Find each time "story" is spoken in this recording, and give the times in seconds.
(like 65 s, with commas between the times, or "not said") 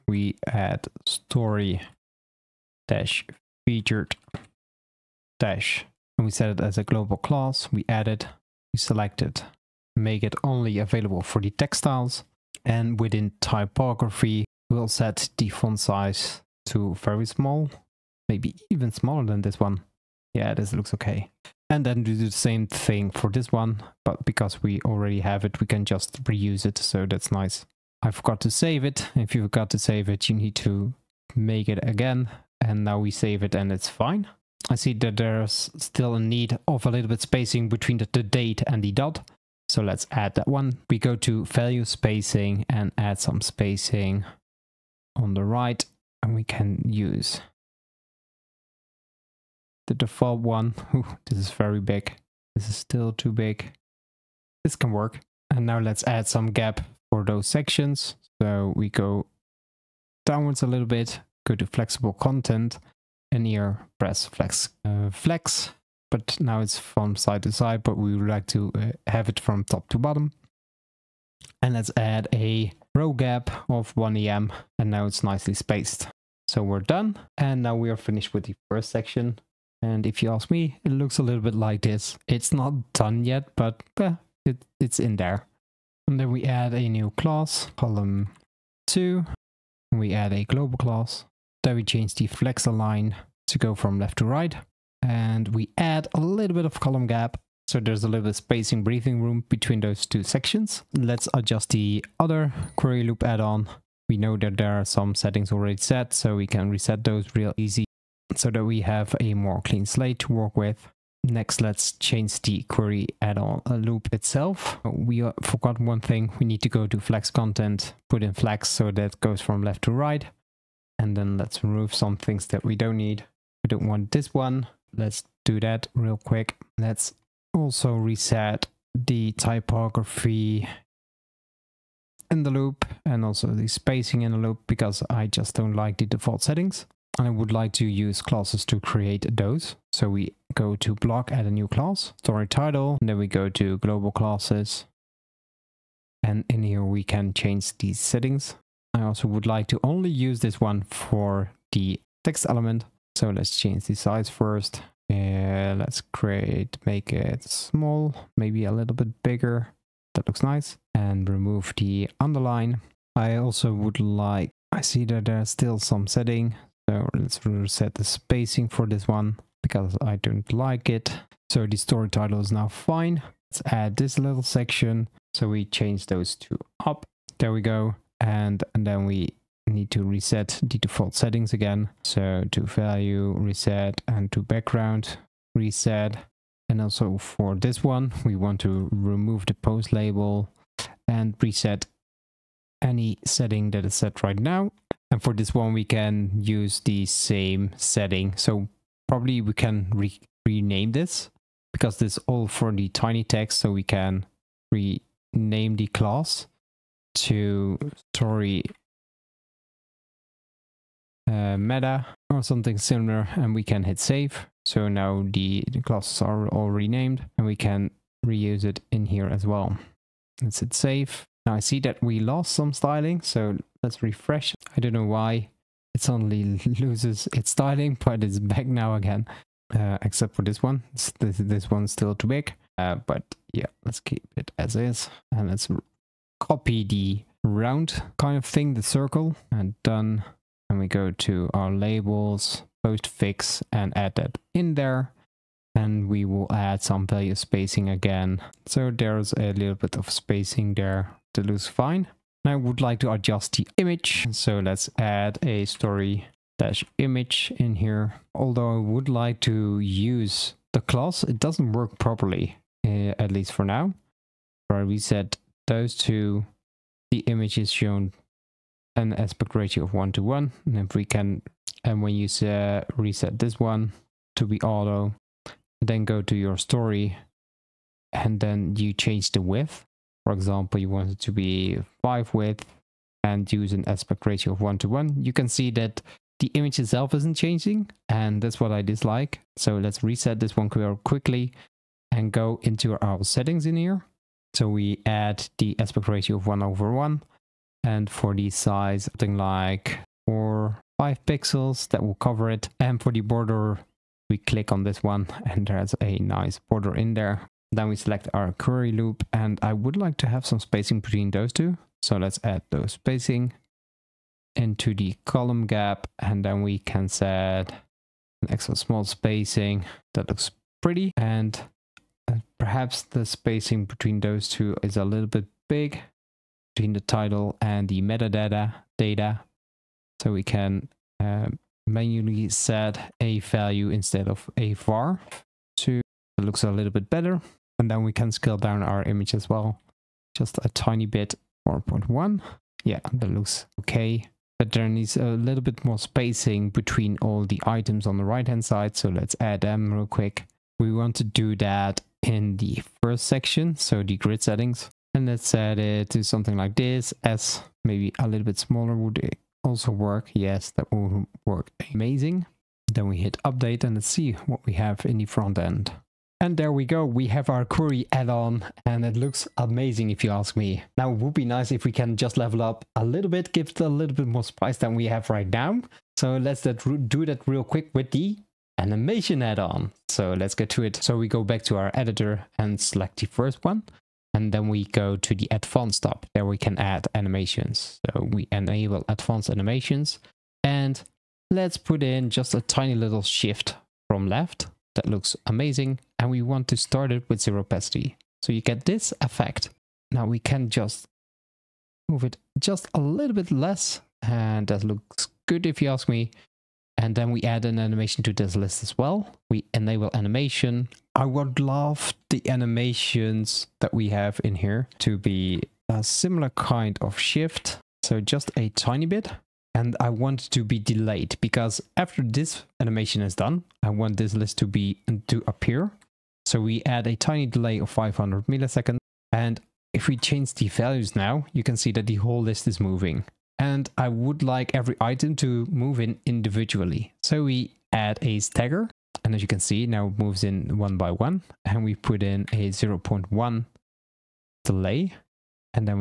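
1 s, 142 s, 171 s, 208 s, 255 s, 276 s.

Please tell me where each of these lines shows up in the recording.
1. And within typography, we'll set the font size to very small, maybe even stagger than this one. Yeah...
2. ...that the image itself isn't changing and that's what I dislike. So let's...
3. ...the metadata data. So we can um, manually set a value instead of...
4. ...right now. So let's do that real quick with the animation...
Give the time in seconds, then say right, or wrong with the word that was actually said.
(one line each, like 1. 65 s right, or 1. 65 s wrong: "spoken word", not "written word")
1. 12 s wrong: "smaller", not "stagger"
2. 285 s right
3. 327 s right
4. 375 s right.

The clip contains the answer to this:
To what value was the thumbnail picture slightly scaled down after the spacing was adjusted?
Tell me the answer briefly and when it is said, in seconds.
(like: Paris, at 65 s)
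4.1, at 341 s.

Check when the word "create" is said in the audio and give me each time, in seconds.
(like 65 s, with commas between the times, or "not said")
138 s, 156 s.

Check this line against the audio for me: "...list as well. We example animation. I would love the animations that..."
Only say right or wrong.
wrong.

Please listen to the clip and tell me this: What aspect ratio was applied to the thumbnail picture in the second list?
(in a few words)
1 over 1.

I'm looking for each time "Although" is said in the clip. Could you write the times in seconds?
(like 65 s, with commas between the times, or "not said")
258 s.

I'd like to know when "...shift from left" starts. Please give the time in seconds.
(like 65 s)
393 s.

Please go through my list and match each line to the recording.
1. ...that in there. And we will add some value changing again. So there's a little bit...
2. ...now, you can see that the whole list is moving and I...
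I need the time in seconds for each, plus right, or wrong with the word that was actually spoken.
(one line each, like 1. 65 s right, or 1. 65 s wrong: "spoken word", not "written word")
1. 244 s wrong: "spacing", not "changing"
2. 431 s right.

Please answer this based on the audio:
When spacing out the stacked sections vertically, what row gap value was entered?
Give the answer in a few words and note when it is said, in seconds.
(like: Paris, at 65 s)
1 em, at 73 s.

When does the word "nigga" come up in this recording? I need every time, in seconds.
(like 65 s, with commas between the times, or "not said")
not said.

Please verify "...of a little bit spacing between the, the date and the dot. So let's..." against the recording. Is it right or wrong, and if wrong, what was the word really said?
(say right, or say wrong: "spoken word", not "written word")
right.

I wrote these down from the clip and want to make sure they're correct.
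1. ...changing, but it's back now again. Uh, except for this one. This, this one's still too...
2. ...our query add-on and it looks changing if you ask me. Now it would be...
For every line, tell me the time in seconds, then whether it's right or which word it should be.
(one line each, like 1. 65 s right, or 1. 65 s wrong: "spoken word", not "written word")
1. 227 s wrong: "styling", not "changing"
2. 367 s wrong: "amazing", not "changing".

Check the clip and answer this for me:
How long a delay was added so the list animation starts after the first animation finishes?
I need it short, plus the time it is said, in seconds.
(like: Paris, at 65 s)
500 milliseconds, at 427 s.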